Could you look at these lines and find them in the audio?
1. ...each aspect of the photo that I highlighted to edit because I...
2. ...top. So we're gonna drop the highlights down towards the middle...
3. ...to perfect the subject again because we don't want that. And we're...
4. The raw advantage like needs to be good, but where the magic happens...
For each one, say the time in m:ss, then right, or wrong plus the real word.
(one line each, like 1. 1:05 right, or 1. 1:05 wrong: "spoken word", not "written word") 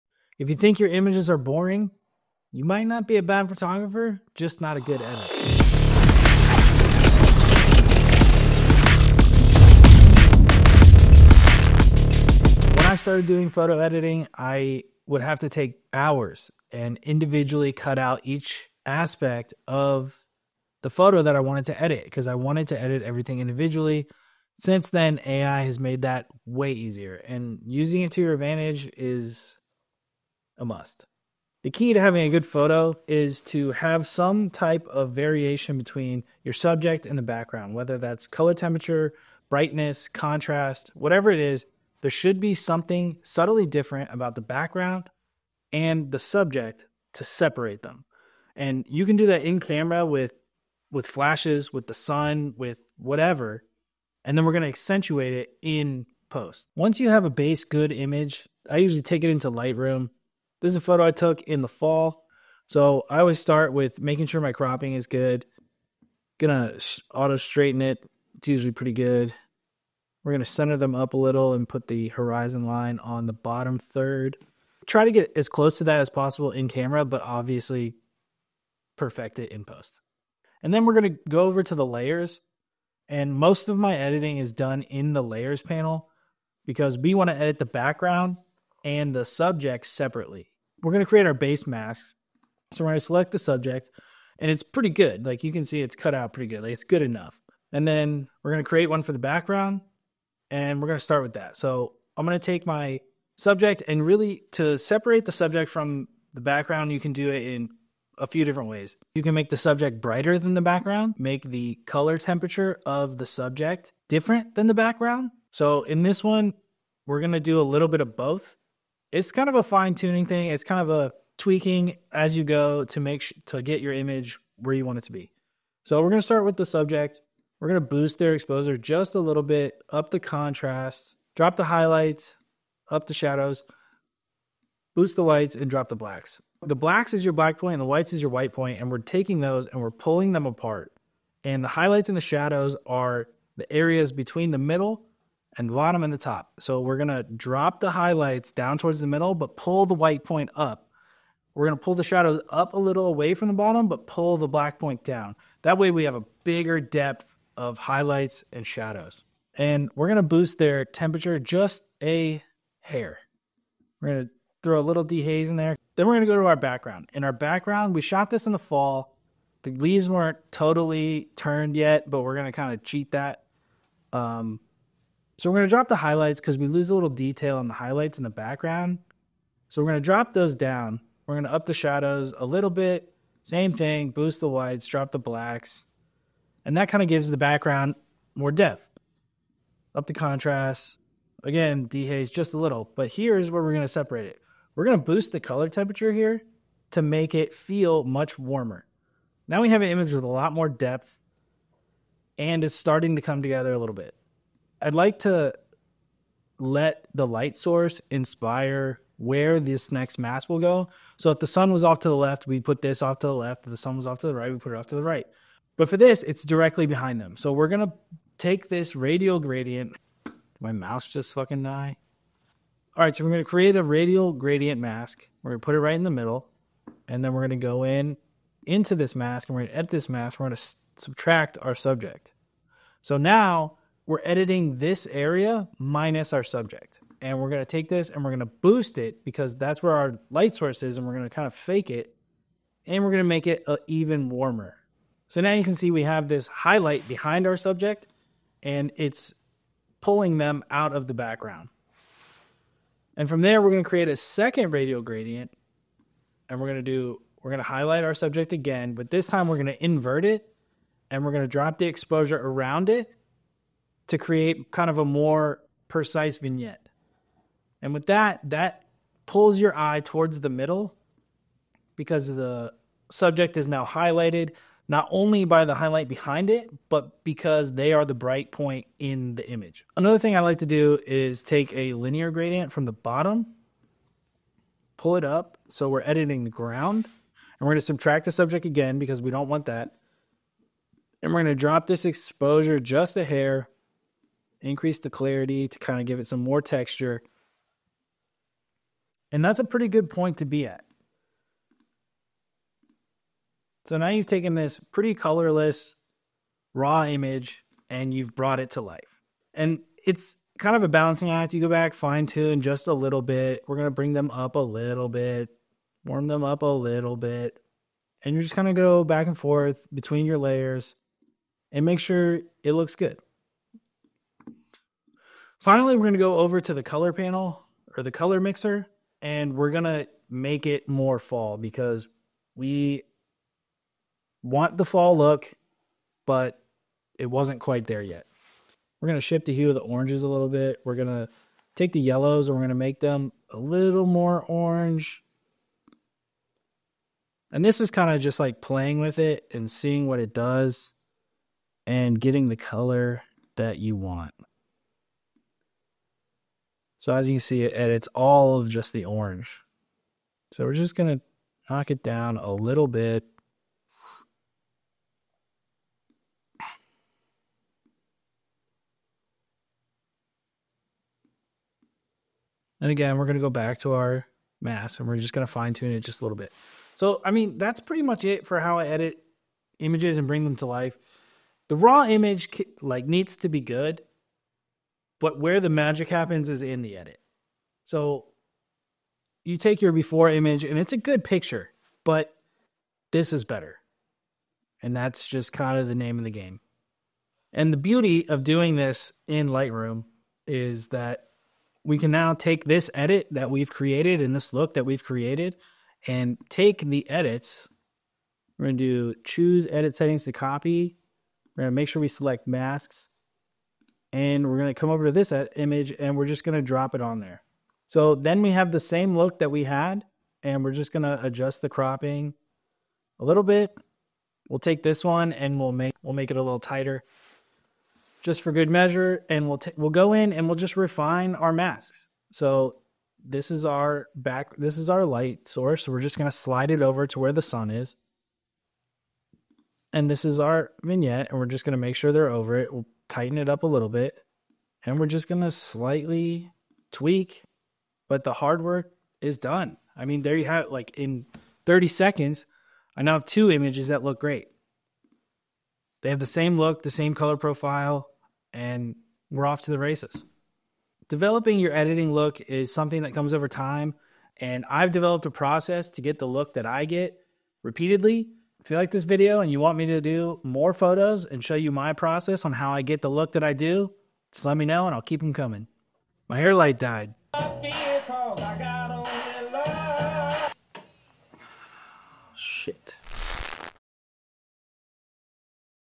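1. 0:18 wrong: "wanted", not "highlighted"
2. 2:26 right
3. 4:47 wrong: "subtract", not "perfect"
4. 6:21 wrong: "image", not "advantage".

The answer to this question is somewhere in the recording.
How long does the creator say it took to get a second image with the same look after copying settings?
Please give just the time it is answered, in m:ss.
7:31.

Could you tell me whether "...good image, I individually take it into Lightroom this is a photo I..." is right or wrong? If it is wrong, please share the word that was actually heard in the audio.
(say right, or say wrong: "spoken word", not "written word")
wrong: "usually", not "individually".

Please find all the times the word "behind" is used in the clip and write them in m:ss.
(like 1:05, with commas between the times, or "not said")
3:36, 4:07, 4:36.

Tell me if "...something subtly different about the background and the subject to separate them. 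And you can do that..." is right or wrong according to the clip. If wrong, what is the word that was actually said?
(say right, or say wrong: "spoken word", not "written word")
right.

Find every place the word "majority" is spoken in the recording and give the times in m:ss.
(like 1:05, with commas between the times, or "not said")
not said.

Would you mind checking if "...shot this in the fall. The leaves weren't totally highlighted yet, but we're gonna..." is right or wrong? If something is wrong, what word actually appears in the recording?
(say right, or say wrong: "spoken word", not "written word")
wrong: "turned", not "highlighted".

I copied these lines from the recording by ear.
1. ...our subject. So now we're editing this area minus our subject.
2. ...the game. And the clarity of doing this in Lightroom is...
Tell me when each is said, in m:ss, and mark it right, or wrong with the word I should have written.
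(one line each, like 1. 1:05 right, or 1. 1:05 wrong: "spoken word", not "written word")
1. 3:51 right
2. 6:36 wrong: "beauty", not "clarity".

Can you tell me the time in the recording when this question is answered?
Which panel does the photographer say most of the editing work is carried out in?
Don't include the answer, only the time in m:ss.
1:25.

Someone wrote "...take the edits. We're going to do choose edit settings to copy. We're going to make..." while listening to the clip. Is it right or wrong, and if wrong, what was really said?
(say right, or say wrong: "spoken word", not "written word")
right.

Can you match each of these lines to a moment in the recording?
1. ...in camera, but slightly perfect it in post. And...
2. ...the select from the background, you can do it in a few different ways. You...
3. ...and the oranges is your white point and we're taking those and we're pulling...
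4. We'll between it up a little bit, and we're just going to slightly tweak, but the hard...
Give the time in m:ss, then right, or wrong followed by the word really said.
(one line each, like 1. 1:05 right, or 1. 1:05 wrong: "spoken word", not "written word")
1. 1:16 wrong: "obviously", not "slightly"
2. 1:45 wrong: "subject", not "select"
3. 2:17 wrong: "whites", not "oranges"
4. 7:22 wrong: "tighten", not "between".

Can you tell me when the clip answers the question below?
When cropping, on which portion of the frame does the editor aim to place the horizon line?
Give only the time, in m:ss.
1:13.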